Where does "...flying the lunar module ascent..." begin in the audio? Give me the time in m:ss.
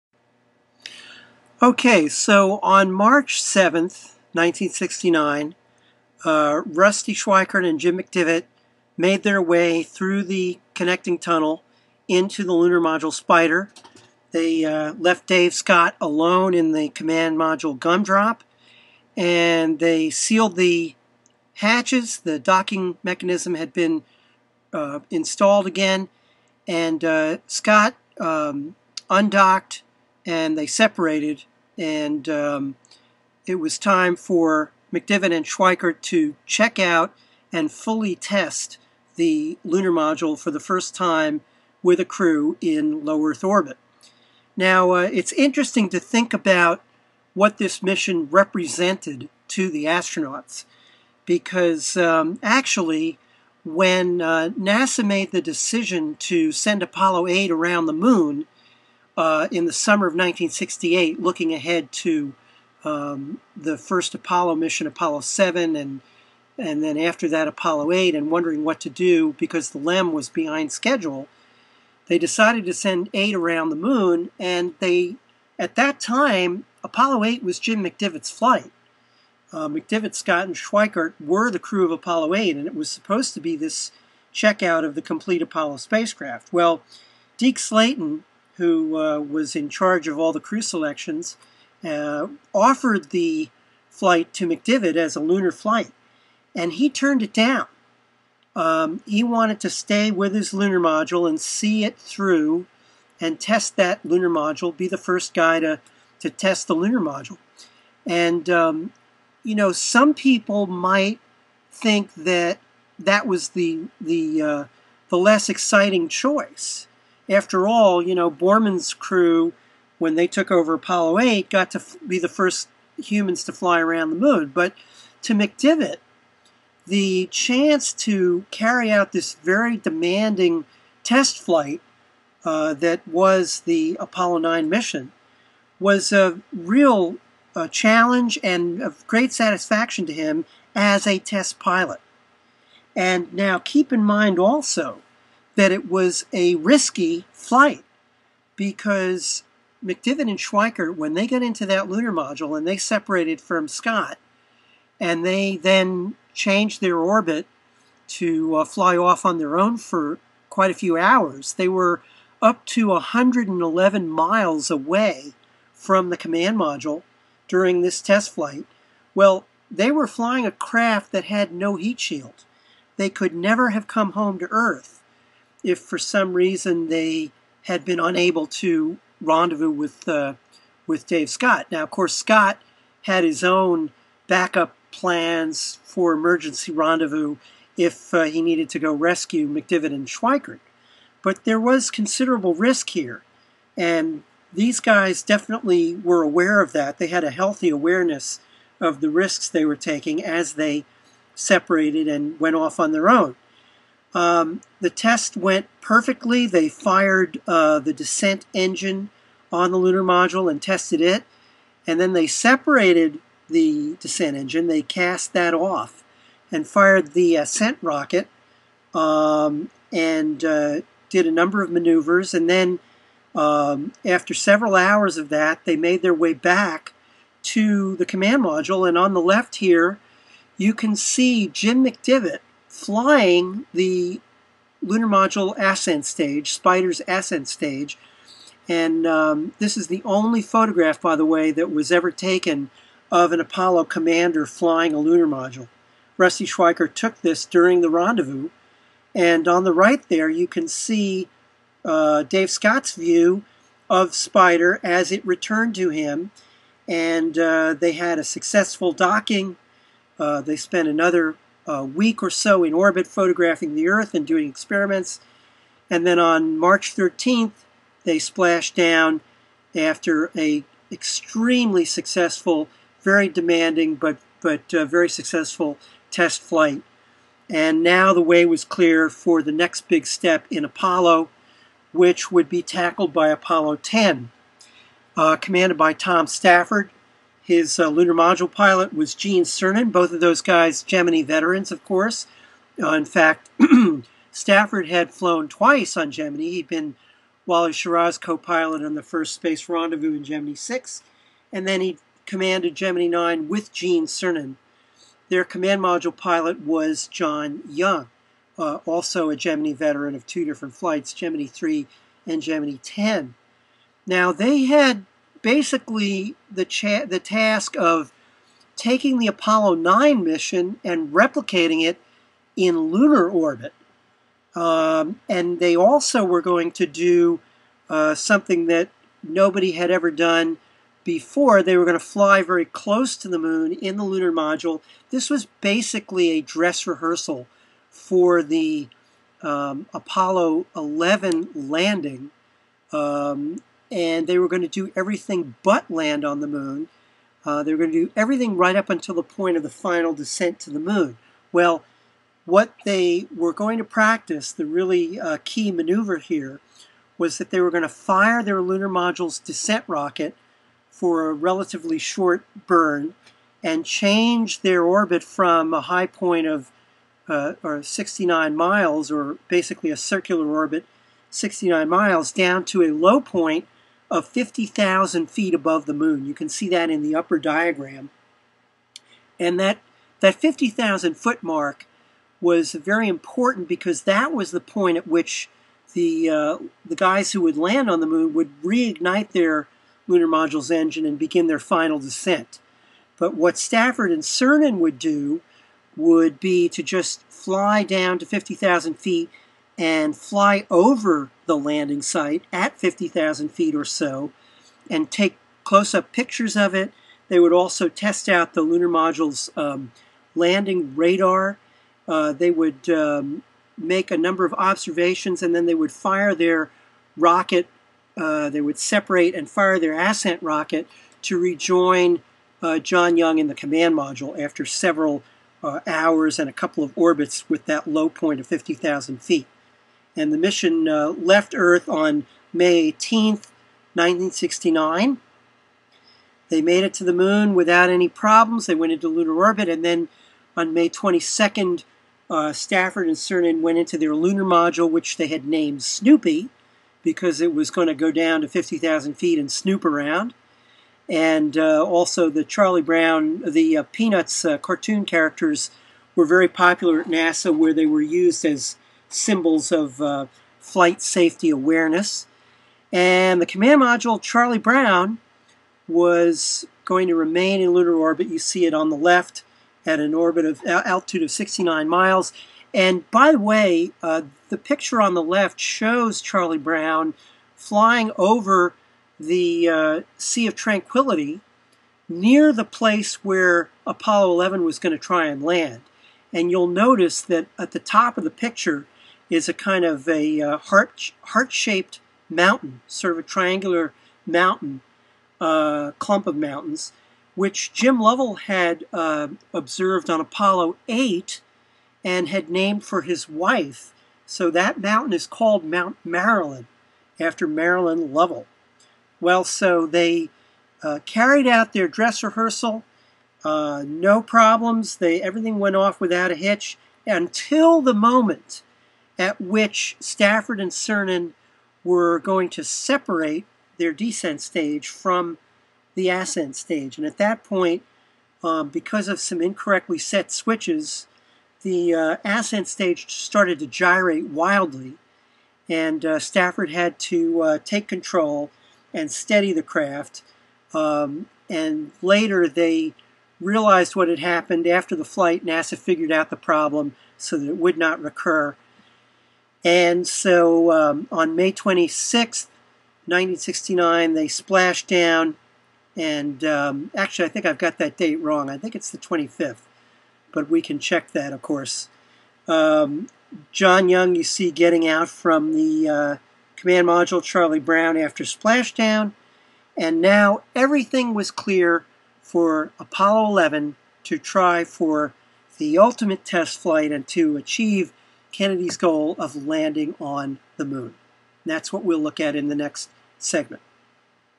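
3:52.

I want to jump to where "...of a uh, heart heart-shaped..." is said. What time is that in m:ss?
8:09.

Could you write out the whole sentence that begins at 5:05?
Their command module pilot was John Young, uh, also a Gemini veteran of two different flights, Gemini 3 and Gemini 10.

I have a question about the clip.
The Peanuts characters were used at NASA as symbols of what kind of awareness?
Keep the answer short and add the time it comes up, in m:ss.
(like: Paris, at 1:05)
flight safety, at 7:40.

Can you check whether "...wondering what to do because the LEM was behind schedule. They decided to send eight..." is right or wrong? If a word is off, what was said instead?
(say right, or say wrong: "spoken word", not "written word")
right.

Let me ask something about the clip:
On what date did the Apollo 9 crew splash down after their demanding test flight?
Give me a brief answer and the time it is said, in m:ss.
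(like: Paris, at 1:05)
March 13th, at 4:26.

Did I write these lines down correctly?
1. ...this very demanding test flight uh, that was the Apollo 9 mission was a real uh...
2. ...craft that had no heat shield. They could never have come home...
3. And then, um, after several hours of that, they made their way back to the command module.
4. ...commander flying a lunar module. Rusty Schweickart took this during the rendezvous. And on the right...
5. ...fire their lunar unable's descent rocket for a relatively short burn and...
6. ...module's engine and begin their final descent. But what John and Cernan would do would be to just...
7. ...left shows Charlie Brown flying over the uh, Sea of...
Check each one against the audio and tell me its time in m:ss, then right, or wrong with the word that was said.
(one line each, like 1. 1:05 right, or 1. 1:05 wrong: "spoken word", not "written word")
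1. 2:09 right
2. 2:50 right
3. 3:42 right
4. 4:03 right
5. 5:57 wrong: "module", not "unable"
6. 6:30 wrong: "Stafford", not "John"
7. 7:55 right.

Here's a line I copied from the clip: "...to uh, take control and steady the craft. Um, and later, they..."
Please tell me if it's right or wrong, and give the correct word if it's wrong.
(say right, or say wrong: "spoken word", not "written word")
right.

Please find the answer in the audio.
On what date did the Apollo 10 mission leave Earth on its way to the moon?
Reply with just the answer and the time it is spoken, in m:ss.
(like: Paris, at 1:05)
May 18th, 1969, at 7:12.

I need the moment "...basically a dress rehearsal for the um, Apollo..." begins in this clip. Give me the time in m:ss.
5:35.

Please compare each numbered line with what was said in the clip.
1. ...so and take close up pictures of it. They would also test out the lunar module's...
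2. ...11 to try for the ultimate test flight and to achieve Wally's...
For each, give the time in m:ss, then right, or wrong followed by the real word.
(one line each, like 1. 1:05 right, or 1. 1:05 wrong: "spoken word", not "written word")
1. 6:43 right
2. 9:33 wrong: "Kennedy", not "Wally".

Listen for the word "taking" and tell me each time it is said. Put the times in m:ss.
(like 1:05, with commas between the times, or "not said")
3:19, 5:18.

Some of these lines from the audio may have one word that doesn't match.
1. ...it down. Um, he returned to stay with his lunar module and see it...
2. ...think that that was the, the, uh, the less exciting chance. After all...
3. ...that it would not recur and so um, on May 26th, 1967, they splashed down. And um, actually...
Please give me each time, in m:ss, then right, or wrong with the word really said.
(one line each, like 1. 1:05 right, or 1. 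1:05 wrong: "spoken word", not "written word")
1. 1:37 wrong: "wanted", not "returned"
2. 1:51 wrong: "choice", not "chance"
3. 9:07 wrong: "1969", not "1967".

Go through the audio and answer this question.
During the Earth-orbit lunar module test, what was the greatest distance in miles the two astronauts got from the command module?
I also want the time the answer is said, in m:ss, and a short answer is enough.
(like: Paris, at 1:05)
111 miles, at 2:42.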